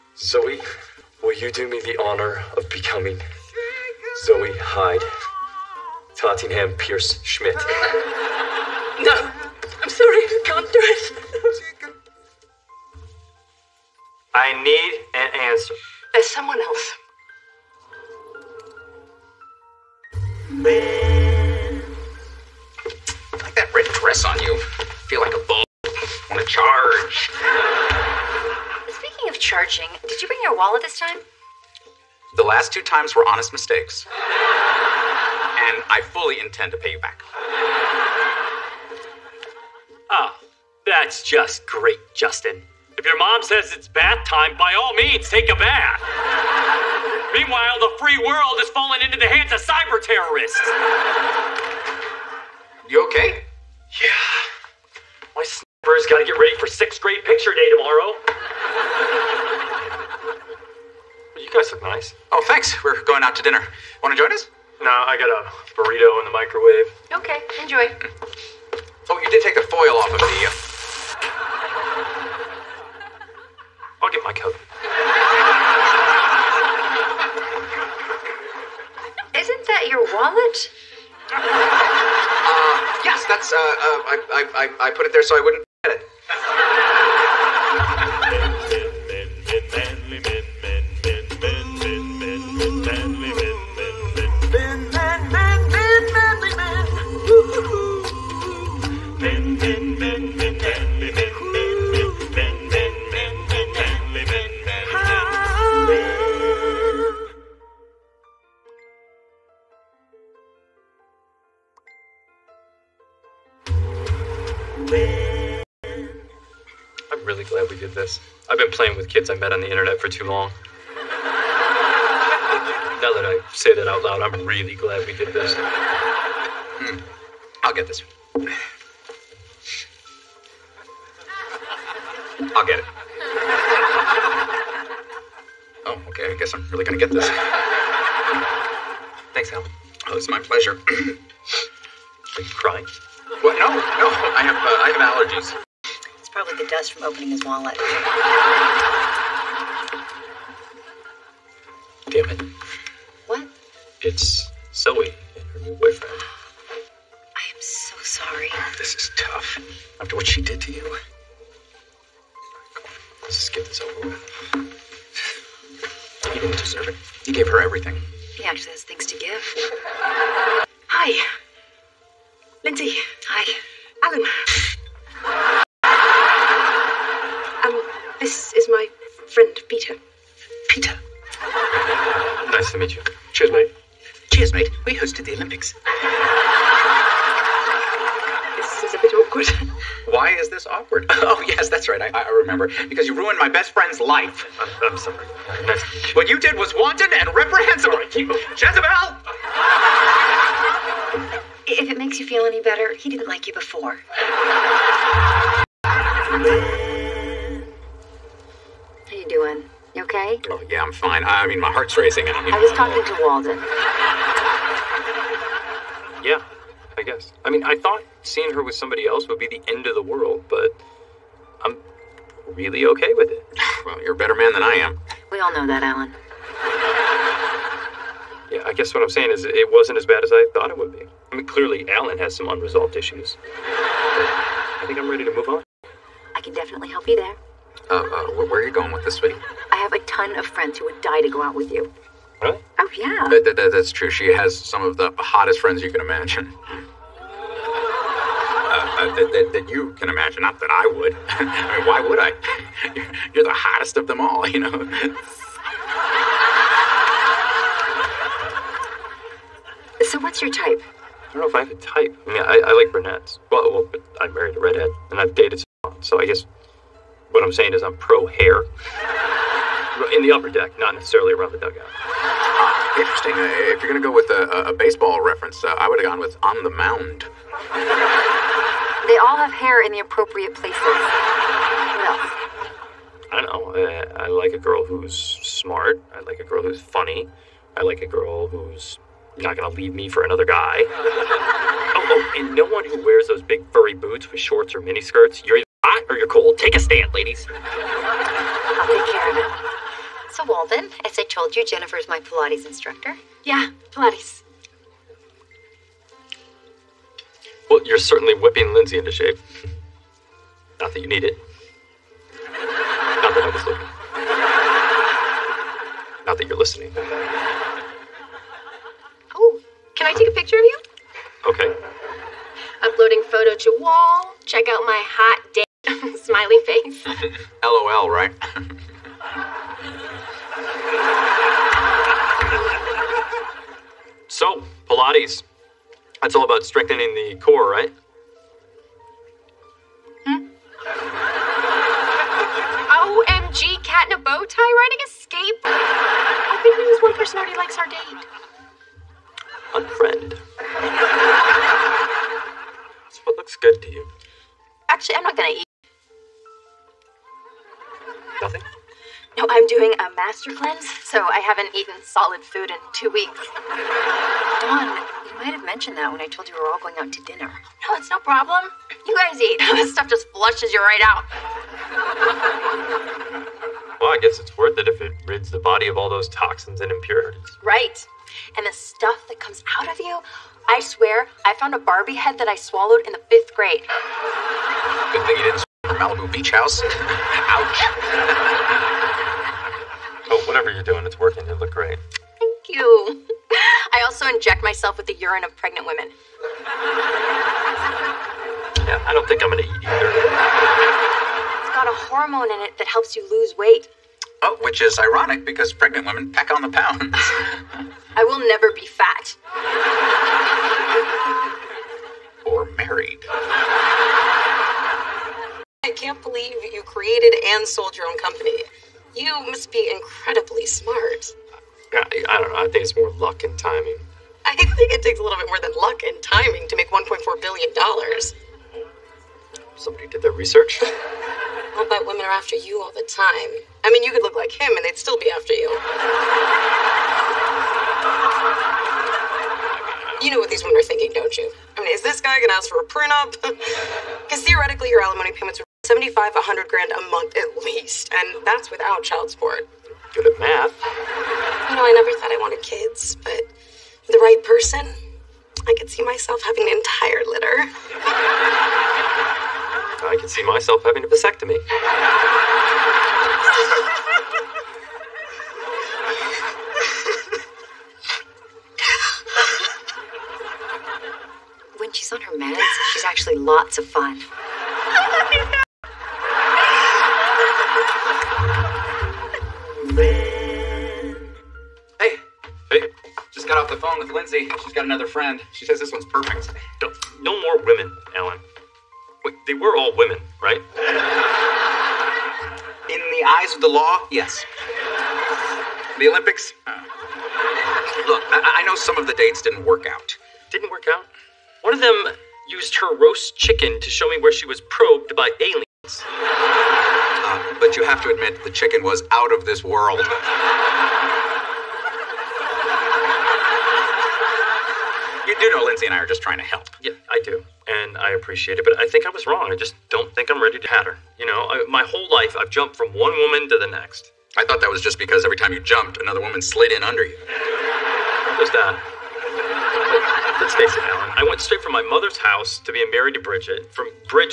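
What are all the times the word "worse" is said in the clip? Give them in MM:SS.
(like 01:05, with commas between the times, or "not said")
not said.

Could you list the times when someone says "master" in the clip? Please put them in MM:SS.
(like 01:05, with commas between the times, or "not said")
06:00.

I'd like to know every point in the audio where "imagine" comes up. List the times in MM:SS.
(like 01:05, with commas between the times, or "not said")
04:06, 04:10.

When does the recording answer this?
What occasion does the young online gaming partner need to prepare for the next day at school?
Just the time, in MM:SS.
00:56.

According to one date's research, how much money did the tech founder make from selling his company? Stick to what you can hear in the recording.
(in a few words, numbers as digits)
$1.4 billion.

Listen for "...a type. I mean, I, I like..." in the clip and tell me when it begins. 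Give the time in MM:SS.
04:21.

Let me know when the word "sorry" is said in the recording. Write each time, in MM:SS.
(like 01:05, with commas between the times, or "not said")
00:09, 02:38, 03:14.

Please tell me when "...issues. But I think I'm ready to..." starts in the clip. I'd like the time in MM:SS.
03:52.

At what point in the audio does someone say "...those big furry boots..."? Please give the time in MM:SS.
04:53.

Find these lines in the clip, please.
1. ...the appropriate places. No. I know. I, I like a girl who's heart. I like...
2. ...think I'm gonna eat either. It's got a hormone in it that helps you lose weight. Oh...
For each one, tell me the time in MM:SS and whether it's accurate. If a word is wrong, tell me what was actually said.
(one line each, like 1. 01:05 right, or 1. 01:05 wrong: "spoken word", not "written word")
1. 04:39 wrong: "smart", not "heart"
2. 06:39 right.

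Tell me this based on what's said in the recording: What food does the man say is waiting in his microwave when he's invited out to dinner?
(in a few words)
burrito.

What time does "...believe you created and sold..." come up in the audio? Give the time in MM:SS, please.
06:56.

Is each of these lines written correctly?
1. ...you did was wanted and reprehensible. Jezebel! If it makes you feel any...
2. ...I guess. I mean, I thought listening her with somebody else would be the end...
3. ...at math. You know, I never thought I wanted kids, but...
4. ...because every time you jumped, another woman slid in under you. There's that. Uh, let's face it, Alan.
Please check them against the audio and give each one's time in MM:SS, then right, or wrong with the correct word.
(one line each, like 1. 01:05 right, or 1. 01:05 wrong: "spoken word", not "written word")
1. 03:16 right
2. 03:36 wrong: "seeing", not "listening"
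3. 07:30 right
4. 08:44 right.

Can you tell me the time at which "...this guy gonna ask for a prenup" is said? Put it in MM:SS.
07:22.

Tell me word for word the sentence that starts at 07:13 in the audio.
I mean, you could look like him and they'd still be after you.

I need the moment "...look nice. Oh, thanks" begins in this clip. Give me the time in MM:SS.
01:01.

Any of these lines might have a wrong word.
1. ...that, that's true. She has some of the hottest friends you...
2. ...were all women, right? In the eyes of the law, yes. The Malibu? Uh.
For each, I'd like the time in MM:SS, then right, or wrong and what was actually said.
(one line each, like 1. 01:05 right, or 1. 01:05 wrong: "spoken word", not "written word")
1. 04:03 right
2. 08:09 wrong: "Olympics", not "Malibu".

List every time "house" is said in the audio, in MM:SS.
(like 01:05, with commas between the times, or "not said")
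06:26, 08:52.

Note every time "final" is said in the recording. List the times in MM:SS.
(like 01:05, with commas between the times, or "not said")
not said.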